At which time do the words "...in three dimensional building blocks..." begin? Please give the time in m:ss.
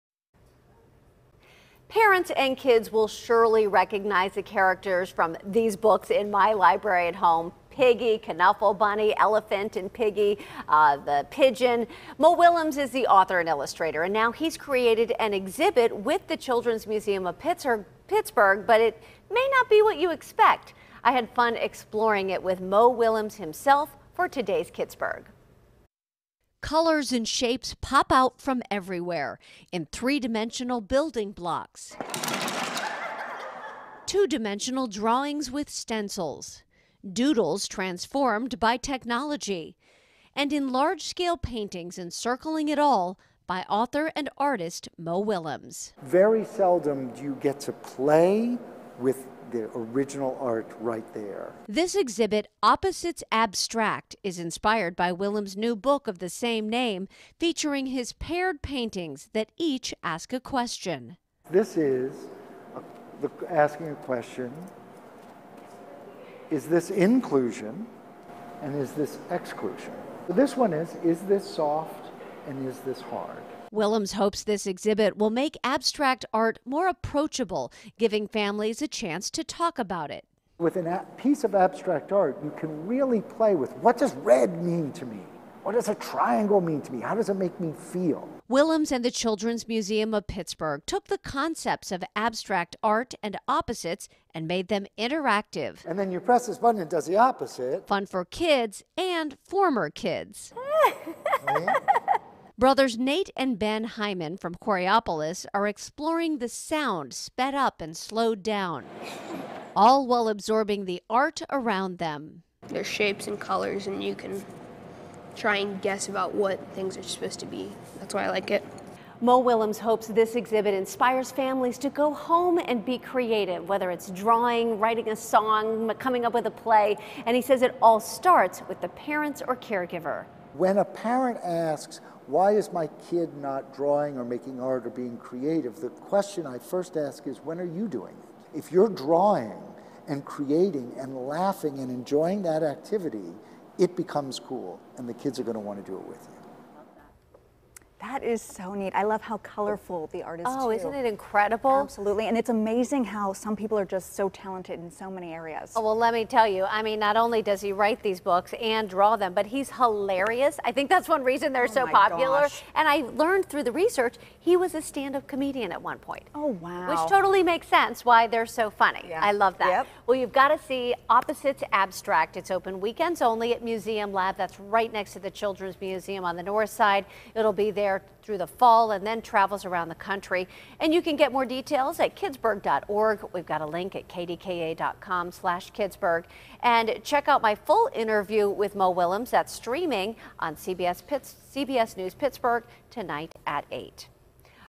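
0:29.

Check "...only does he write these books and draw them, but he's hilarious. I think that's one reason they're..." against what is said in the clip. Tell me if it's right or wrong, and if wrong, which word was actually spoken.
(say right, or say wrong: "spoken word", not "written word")
right.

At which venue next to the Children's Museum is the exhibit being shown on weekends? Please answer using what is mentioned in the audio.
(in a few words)
Museum Lab.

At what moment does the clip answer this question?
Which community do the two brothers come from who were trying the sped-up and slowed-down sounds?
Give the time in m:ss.
1:44.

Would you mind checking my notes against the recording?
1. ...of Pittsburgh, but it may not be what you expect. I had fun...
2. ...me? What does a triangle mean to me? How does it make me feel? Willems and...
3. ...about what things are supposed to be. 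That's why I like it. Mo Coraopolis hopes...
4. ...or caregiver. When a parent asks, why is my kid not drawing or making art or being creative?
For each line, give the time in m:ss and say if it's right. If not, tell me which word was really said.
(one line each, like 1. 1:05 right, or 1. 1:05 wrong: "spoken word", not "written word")
1. 0:17 right
2. 1:25 right
3. 1:56 wrong: "Willems", not "Coraopolis"
4. 2:09 right.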